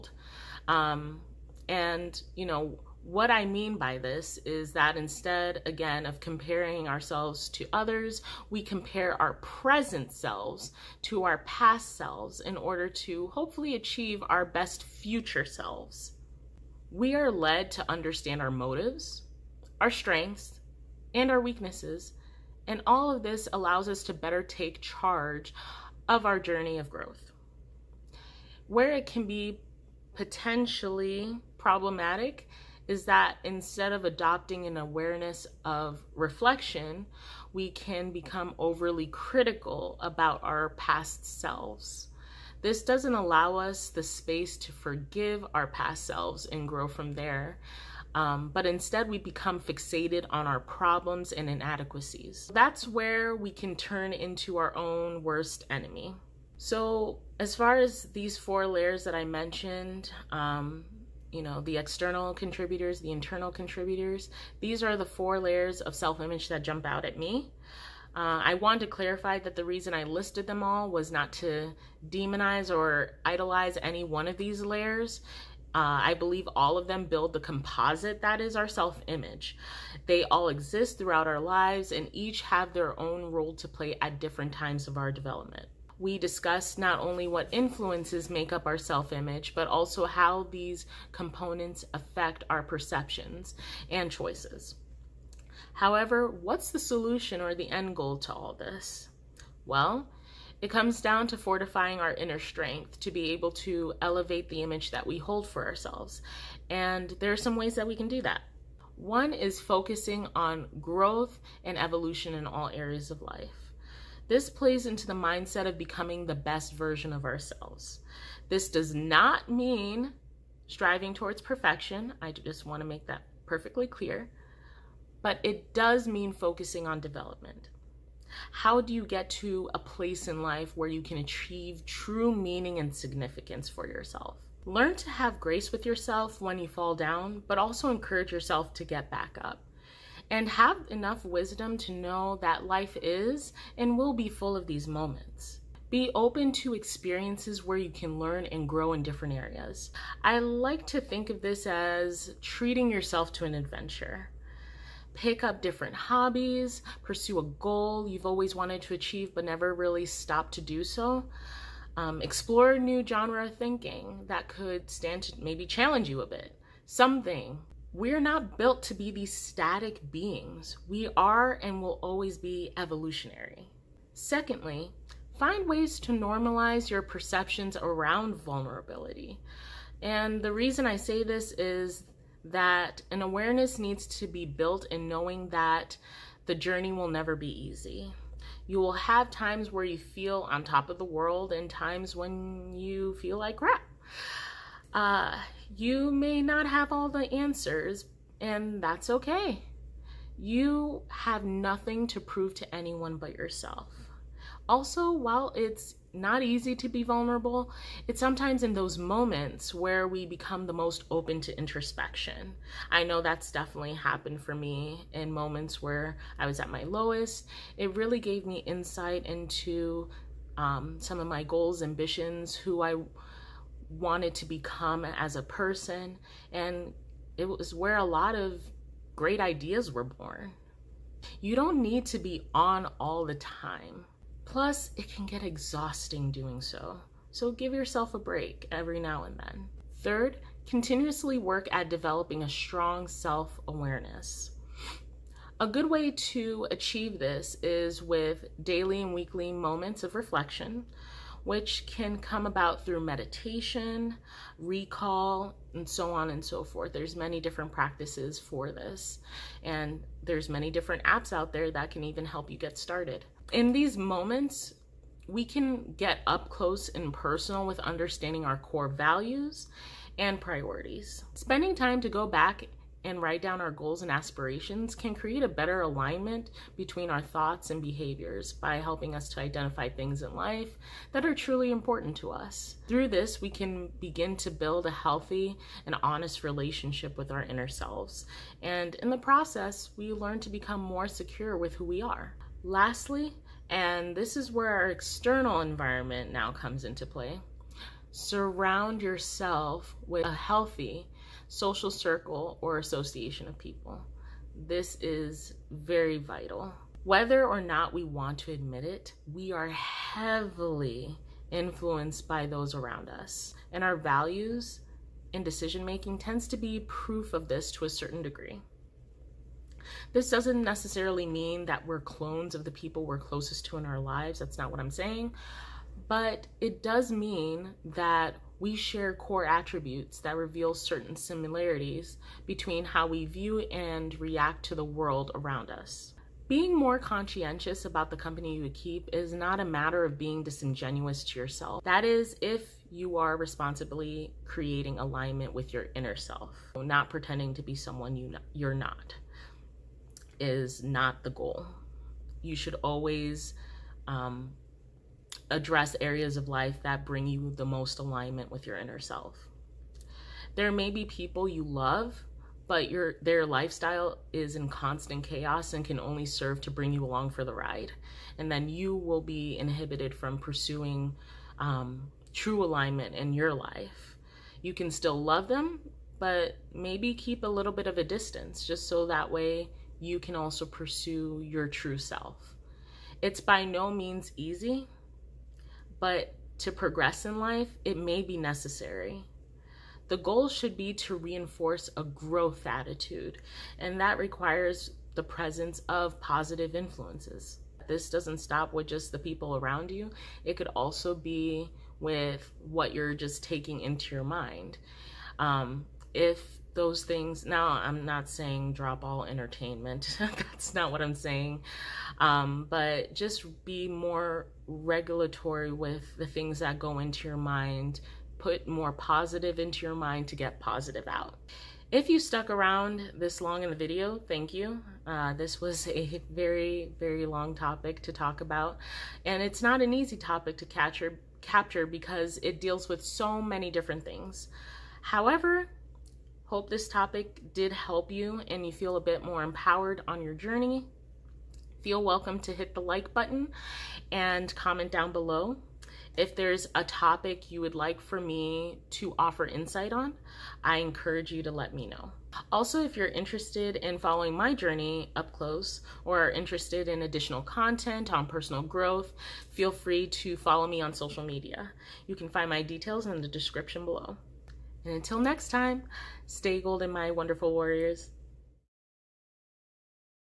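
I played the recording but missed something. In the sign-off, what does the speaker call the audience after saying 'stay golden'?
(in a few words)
wonderful warriors.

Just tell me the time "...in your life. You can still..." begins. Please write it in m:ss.
6:13.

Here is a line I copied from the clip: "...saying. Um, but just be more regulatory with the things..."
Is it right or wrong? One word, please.
right.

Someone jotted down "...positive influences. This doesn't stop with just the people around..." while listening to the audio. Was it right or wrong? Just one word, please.
right.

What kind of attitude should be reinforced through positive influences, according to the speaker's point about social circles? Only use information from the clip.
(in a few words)
growth attitude.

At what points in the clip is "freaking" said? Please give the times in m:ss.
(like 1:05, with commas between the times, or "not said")
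not said.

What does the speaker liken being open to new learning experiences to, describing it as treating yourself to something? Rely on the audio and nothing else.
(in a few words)
an adventure.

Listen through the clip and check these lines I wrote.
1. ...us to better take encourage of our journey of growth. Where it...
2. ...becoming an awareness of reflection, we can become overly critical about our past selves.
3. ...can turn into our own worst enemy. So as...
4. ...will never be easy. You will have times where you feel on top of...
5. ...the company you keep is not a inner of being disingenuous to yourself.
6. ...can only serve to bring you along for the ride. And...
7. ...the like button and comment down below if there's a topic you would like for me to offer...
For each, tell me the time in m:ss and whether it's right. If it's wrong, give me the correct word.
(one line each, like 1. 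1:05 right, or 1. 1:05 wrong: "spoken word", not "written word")
1. 0:23 wrong: "charge", not "encourage"
2. 0:34 wrong: "adopting", not "becoming"
3. 0:53 right
4. 3:06 right
5. 5:38 wrong: "matter", not "inner"
6. 6:05 right
7. 7:22 right.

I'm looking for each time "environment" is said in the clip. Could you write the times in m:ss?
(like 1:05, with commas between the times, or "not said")
4:55.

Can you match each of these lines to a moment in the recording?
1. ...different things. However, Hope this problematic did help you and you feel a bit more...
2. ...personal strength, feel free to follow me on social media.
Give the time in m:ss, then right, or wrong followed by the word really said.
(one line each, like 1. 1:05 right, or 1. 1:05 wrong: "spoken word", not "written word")
1. 7:13 wrong: "topic", not "problematic"
2. 7:38 wrong: "growth", not "strength".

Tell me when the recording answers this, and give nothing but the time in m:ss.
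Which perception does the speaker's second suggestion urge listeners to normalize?
2:58.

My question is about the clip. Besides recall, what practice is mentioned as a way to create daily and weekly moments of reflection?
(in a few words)
meditation.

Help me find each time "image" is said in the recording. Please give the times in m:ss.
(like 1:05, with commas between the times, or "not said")
1:05, 1:19, 1:29, 1:44.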